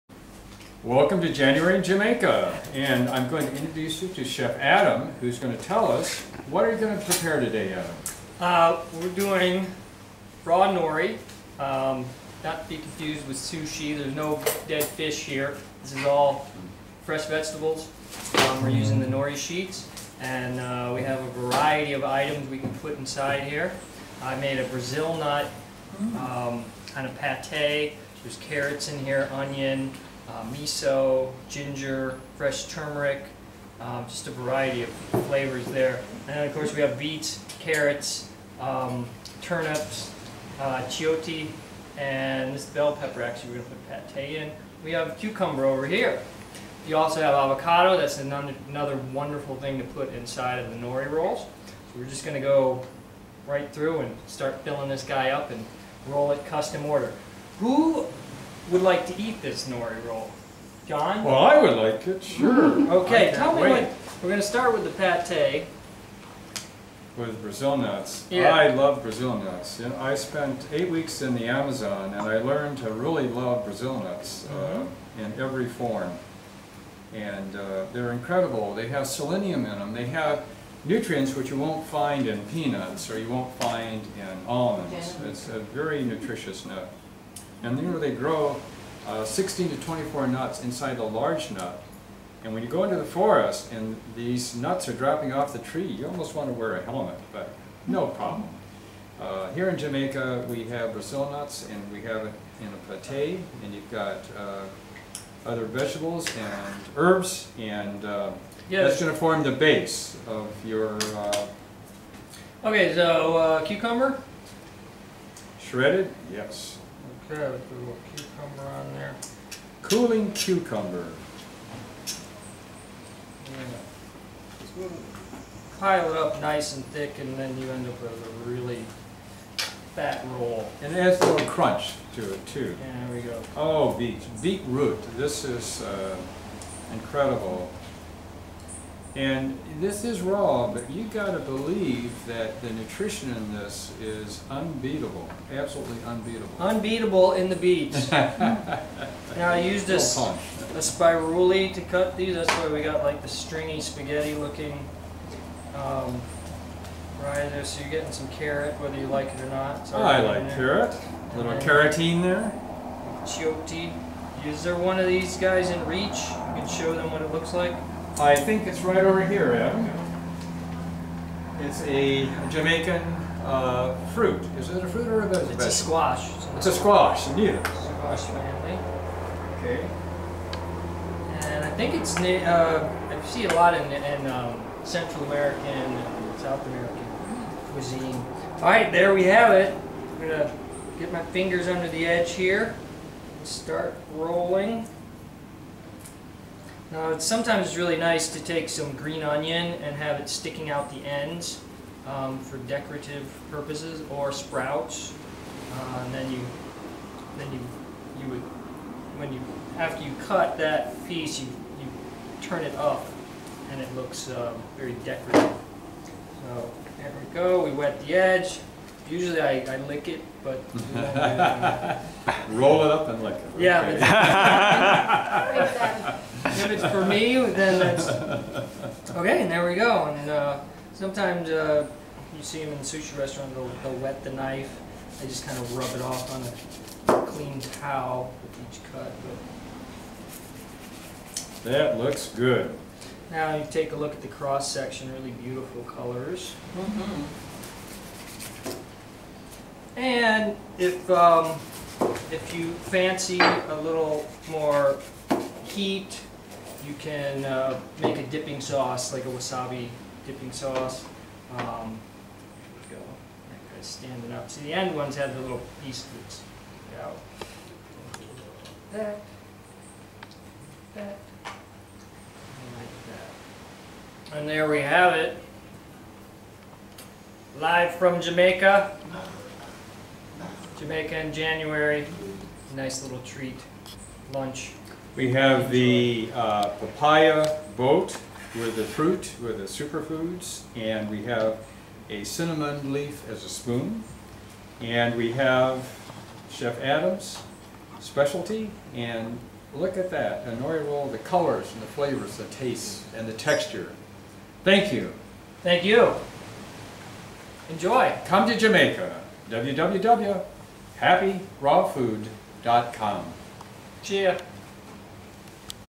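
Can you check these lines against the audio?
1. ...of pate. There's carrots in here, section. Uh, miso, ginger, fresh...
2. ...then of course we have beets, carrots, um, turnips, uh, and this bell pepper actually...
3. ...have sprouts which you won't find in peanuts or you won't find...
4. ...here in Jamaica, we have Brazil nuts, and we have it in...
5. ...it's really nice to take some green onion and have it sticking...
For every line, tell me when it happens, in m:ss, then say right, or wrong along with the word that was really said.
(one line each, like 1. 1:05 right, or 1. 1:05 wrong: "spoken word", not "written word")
1. 0:27 wrong: "onion", not "section"
2. 0:36 right
3. 1:20 wrong: "nutrients", not "sprouts"
4. 1:39 right
5. 3:17 right.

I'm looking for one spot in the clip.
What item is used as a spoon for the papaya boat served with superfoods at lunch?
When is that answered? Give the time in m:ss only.
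4:52.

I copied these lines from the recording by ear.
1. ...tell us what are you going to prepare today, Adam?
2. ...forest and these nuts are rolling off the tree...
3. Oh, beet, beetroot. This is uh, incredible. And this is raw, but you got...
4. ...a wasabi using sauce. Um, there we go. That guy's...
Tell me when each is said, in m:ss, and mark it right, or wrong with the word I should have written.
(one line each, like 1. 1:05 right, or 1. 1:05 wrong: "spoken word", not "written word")
1. 0:05 right
2. 1:33 wrong: "dropping", not "rolling"
3. 2:13 right
4. 4:19 wrong: "dipping", not "using".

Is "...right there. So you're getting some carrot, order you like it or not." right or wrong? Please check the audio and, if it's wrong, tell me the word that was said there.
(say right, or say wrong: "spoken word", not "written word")
wrong: "whether", not "order".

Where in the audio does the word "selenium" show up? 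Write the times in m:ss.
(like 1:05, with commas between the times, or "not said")
1:19.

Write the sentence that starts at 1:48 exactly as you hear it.
that's going to form the base of your...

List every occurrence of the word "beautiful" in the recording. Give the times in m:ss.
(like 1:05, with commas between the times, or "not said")
4:05.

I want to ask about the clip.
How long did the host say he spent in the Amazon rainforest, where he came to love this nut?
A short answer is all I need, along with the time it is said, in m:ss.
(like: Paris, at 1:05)
8 weeks, at 1:10.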